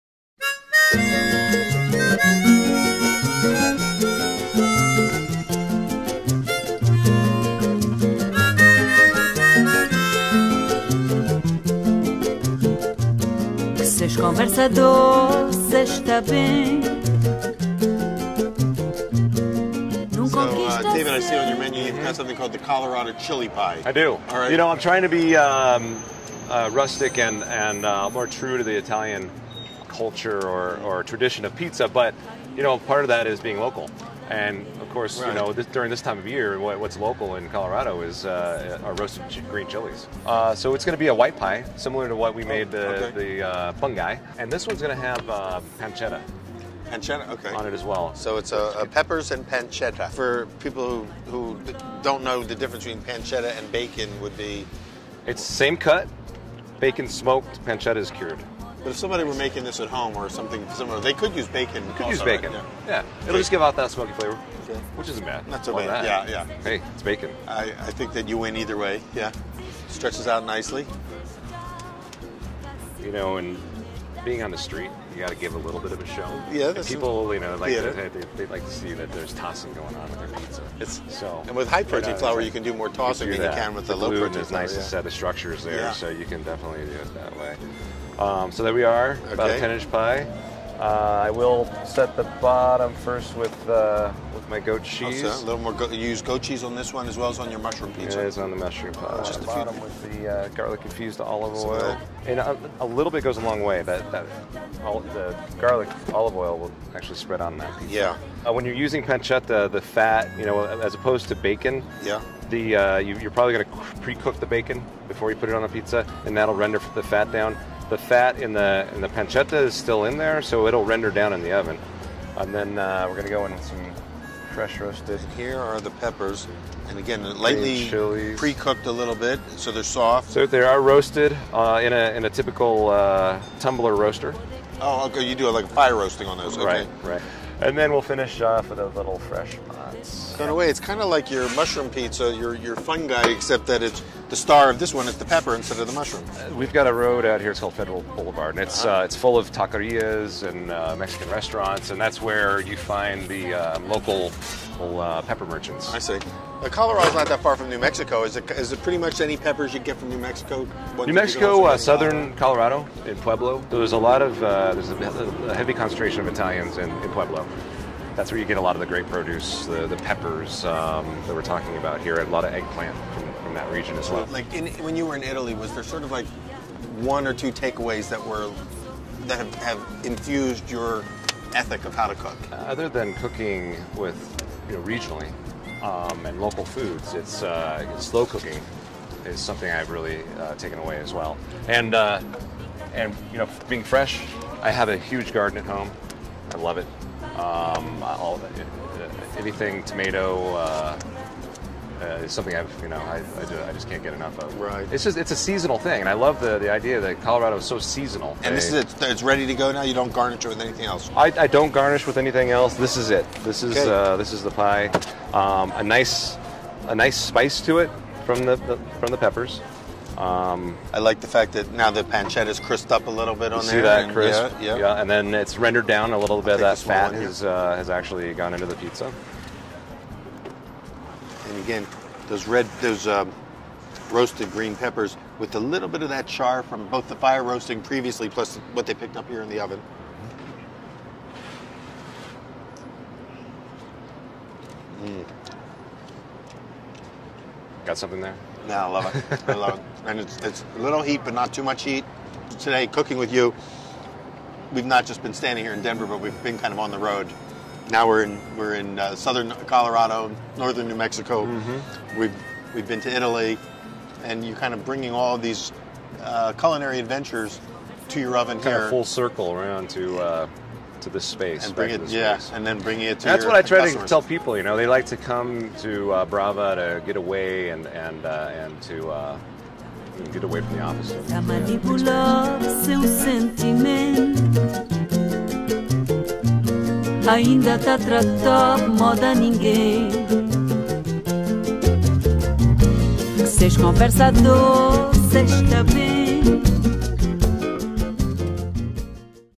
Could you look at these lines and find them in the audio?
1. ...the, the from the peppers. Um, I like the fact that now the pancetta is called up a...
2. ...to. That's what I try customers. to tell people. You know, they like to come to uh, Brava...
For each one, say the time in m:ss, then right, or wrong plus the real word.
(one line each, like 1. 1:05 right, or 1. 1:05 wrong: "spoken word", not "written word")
1. 3:38 wrong: "crisped", not "called"
2. 4:33 right.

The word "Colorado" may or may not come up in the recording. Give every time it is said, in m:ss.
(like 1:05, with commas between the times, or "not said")
0:22, 0:37, 2:36, 2:42, 3:27, 4:19.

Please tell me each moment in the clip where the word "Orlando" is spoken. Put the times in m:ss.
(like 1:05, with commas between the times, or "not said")
not said.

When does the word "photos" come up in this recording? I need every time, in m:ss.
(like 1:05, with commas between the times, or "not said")
not said.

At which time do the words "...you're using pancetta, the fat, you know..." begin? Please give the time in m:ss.
1:48.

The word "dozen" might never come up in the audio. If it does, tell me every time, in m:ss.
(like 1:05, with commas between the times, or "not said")
not said.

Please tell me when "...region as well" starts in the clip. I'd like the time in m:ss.
2:53.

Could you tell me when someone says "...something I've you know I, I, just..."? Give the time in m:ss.
3:22.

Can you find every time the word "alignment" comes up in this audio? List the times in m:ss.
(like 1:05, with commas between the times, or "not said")
not said.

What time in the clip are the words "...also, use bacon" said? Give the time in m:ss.
1:02.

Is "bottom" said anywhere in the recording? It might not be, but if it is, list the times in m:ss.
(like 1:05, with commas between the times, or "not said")
1:32, 1:39.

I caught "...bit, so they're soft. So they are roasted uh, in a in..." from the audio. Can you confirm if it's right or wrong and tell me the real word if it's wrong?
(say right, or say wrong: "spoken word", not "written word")
right.